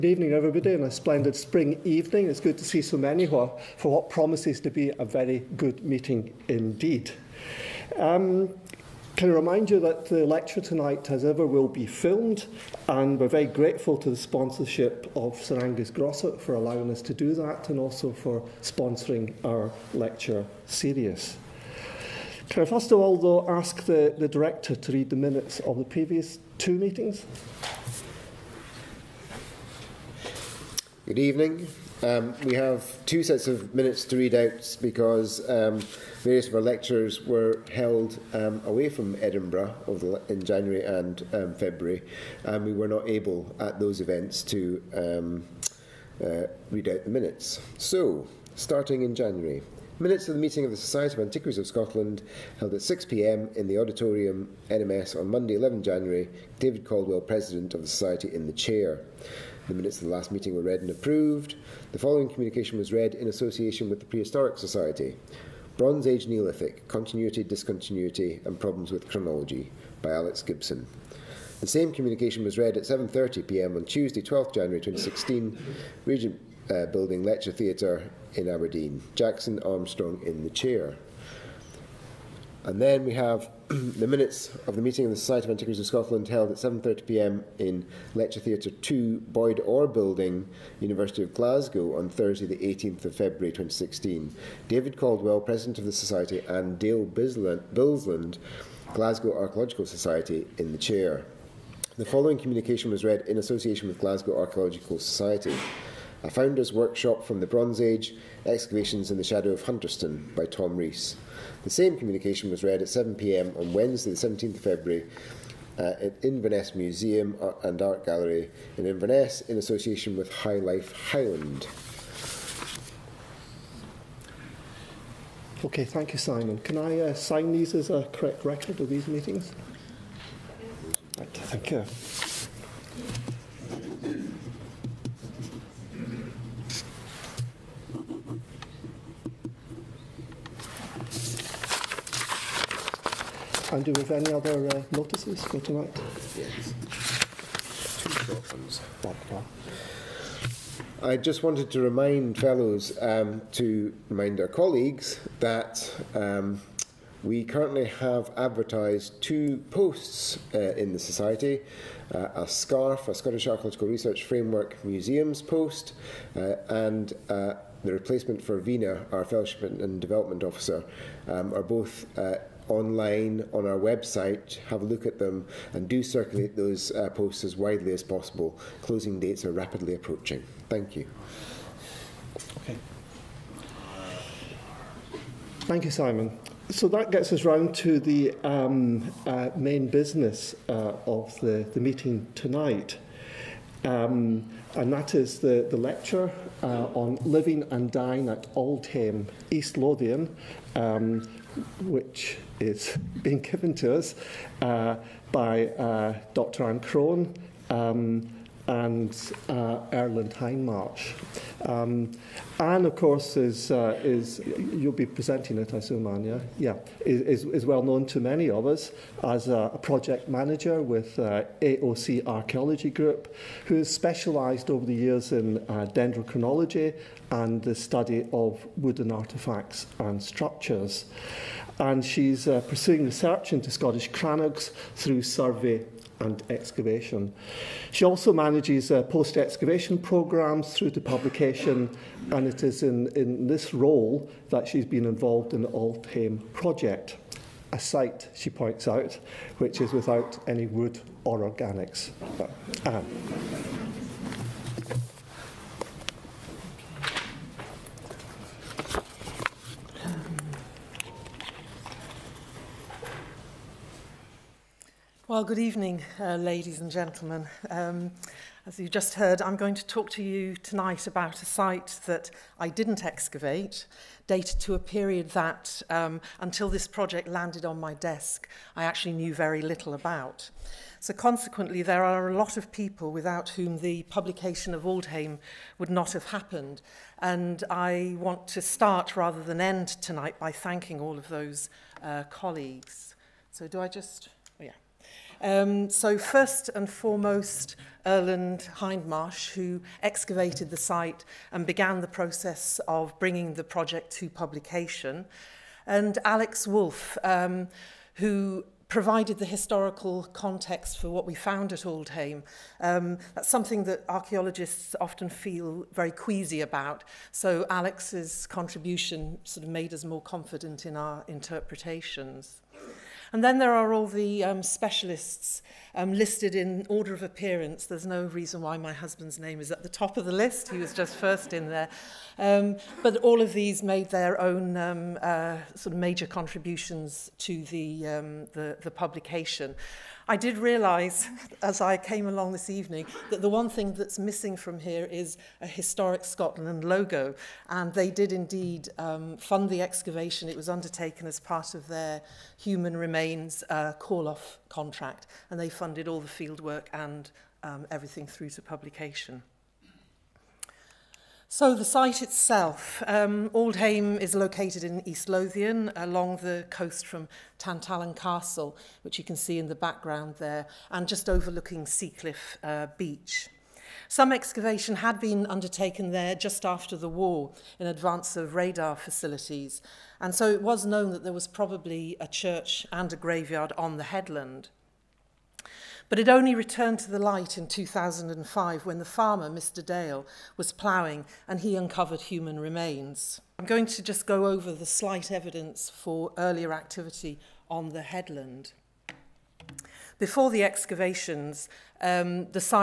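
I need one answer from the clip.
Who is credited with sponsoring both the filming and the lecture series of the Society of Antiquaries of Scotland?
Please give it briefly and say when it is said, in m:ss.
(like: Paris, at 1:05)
Sir Angus Grossart, at 0:15.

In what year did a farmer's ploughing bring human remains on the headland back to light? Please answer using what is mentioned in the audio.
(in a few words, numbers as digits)
2005.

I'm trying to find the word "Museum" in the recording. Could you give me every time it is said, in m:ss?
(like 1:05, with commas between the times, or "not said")
1:56, 2:44.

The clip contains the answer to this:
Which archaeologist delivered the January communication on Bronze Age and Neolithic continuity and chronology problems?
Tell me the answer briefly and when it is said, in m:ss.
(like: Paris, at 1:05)
Alex Gibson, at 1:10.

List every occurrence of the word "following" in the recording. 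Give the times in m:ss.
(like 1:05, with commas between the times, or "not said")
1:01, 1:42.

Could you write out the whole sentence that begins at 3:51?
And she's uh, pursuing research into Scottish crannogs through survey and excavation.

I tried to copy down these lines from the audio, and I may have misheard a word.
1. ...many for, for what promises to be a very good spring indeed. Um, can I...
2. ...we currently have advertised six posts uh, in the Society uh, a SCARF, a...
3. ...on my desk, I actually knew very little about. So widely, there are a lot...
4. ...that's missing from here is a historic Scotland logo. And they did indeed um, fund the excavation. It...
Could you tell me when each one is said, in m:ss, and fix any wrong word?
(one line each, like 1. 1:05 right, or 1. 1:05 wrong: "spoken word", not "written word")
1. 0:02 wrong: "meeting", not "spring"
2. 2:37 wrong: "two", not "six"
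3. 4:37 wrong: "consequently", not "widely"
4. 5:43 right.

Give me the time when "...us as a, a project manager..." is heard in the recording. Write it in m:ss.
3:38.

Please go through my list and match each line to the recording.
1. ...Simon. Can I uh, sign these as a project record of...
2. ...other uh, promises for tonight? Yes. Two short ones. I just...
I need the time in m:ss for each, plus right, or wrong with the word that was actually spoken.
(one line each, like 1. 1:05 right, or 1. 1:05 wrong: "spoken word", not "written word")
1. 2:06 wrong: "correct", not "project"
2. 2:24 wrong: "notices", not "promises".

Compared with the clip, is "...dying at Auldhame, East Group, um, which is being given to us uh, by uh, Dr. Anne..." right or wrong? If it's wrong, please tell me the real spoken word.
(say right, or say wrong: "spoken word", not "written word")
wrong: "Lothian", not "Group".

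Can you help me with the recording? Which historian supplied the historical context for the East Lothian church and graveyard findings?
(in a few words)
Alex Wolfe.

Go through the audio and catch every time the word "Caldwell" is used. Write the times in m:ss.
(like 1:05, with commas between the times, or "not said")
0:56, 1:34.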